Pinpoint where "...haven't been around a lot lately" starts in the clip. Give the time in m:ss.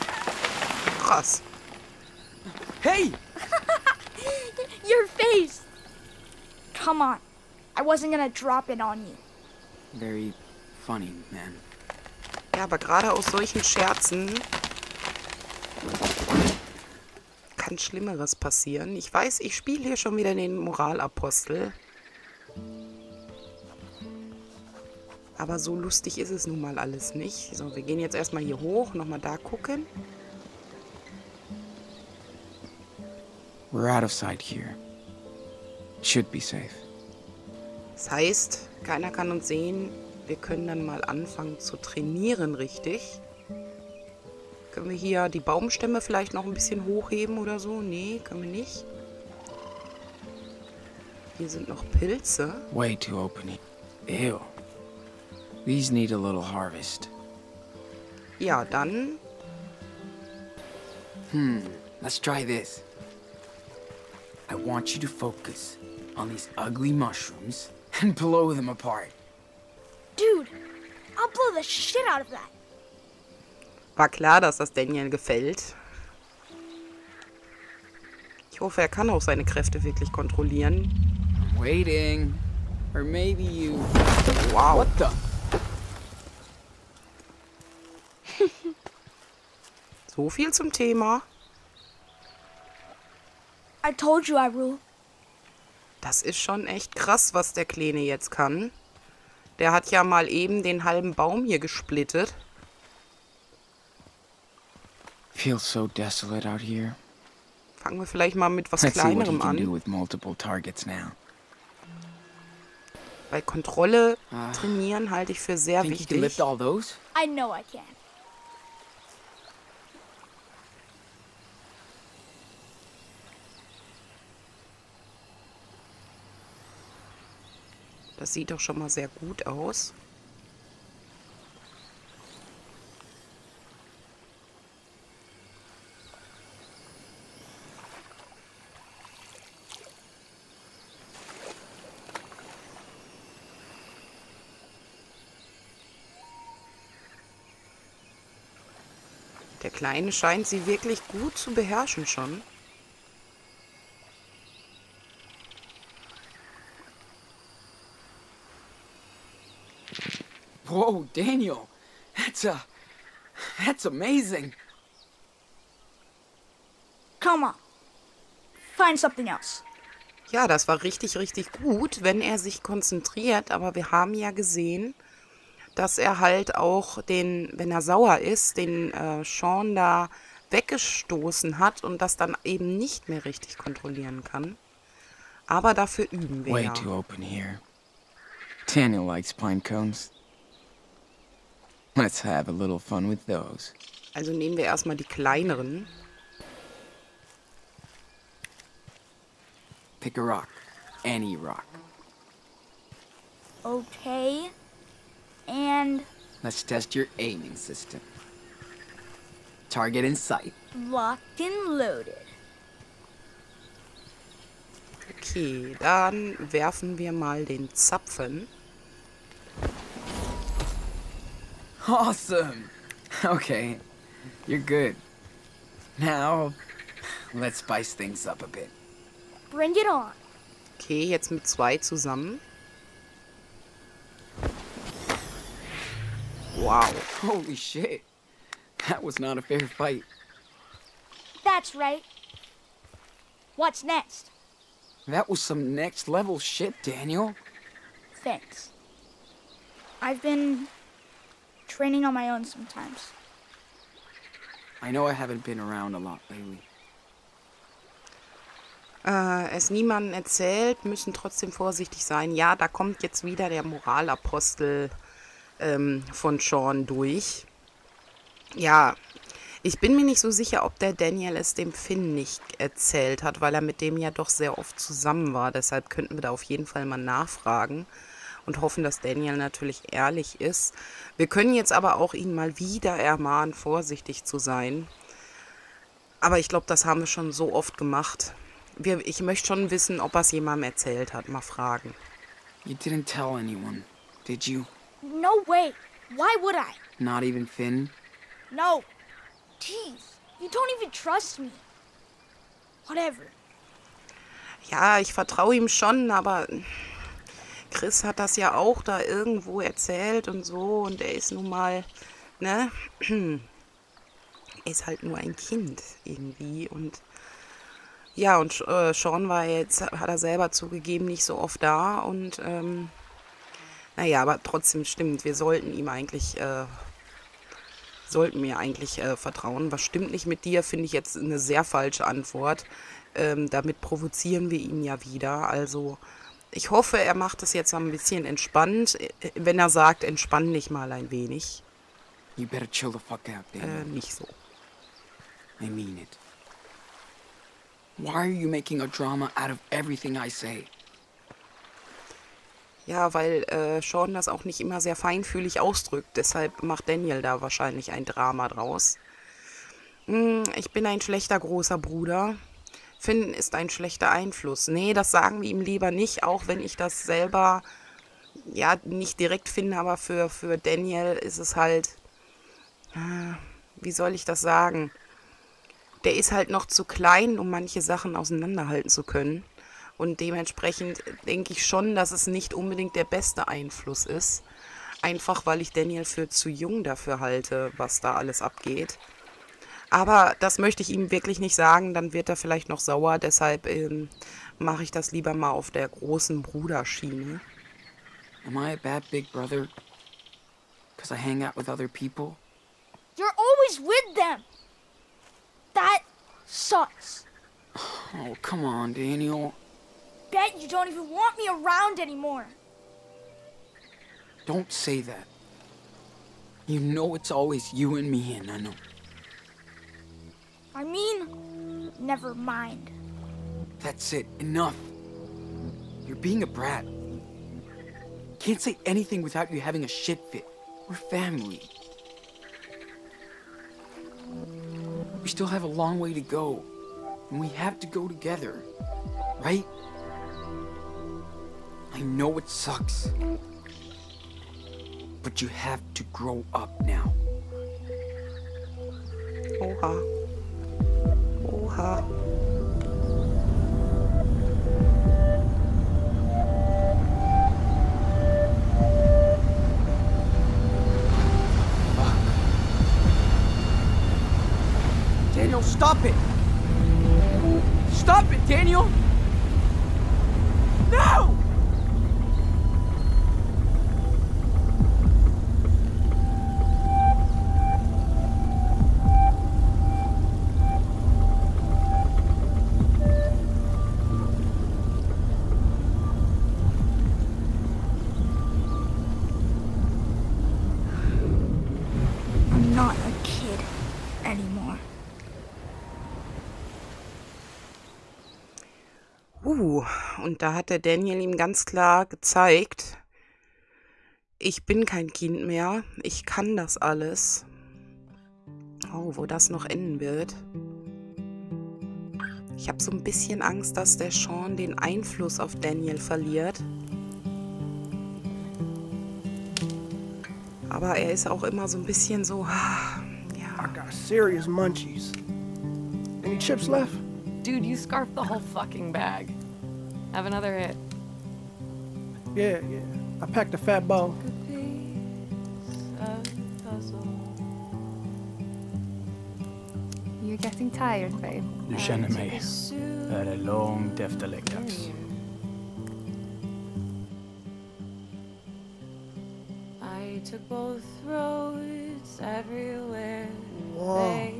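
4:15.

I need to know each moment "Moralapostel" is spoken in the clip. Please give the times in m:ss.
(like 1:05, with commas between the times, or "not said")
0:20, 4:23.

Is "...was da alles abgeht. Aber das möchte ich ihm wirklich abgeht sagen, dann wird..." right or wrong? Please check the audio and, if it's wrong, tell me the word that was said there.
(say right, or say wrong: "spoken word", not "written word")
wrong: "nicht", not "abgeht".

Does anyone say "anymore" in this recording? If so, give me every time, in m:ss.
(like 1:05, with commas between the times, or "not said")
6:51, 8:14.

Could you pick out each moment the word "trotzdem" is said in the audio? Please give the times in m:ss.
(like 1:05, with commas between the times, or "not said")
4:21, 5:24.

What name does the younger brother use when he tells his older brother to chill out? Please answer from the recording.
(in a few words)
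Damon.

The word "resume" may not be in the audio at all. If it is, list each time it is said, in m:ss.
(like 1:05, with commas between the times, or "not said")
not said.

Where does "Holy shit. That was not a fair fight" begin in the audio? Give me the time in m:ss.
3:57.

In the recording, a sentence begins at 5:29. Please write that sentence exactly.
Was stimmt nicht mit dir, finde ich jetzt eine sehr falsche Antwort.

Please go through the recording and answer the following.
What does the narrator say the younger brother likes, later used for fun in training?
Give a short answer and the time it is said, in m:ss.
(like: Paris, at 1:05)
pine cones, at 3:08.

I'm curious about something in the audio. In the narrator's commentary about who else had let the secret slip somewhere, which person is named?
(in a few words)
Chris.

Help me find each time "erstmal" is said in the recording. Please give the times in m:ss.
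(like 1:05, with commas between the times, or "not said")
0:28, 3:14.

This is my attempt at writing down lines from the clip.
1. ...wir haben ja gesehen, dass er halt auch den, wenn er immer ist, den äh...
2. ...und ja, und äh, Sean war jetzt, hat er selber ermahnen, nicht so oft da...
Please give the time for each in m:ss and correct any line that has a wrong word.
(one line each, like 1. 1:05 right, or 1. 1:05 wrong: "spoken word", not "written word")
1. 2:53 wrong: "sauer", not "immer"
2. 5:16 wrong: "zugegeben", not "ermahnen".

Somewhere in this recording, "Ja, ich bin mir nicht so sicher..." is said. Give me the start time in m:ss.
4:28.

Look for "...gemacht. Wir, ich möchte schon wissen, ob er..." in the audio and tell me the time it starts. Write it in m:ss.
4:47.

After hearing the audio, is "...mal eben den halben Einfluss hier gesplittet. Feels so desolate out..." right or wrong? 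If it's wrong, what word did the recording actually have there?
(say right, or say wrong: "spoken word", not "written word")
wrong: "Baum", not "Einfluss".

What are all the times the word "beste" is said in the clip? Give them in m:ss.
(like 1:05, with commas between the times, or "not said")
6:23.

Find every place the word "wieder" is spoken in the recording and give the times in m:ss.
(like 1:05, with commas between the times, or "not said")
0:20, 4:23, 4:42, 5:35.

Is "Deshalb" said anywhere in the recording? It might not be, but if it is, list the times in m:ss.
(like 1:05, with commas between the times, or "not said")
4:35, 5:56, 6:33.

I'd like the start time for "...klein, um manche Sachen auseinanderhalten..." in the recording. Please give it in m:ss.
6:16.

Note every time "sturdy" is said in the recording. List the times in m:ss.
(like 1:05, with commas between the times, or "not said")
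not said.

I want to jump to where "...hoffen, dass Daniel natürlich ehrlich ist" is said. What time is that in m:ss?
4:38.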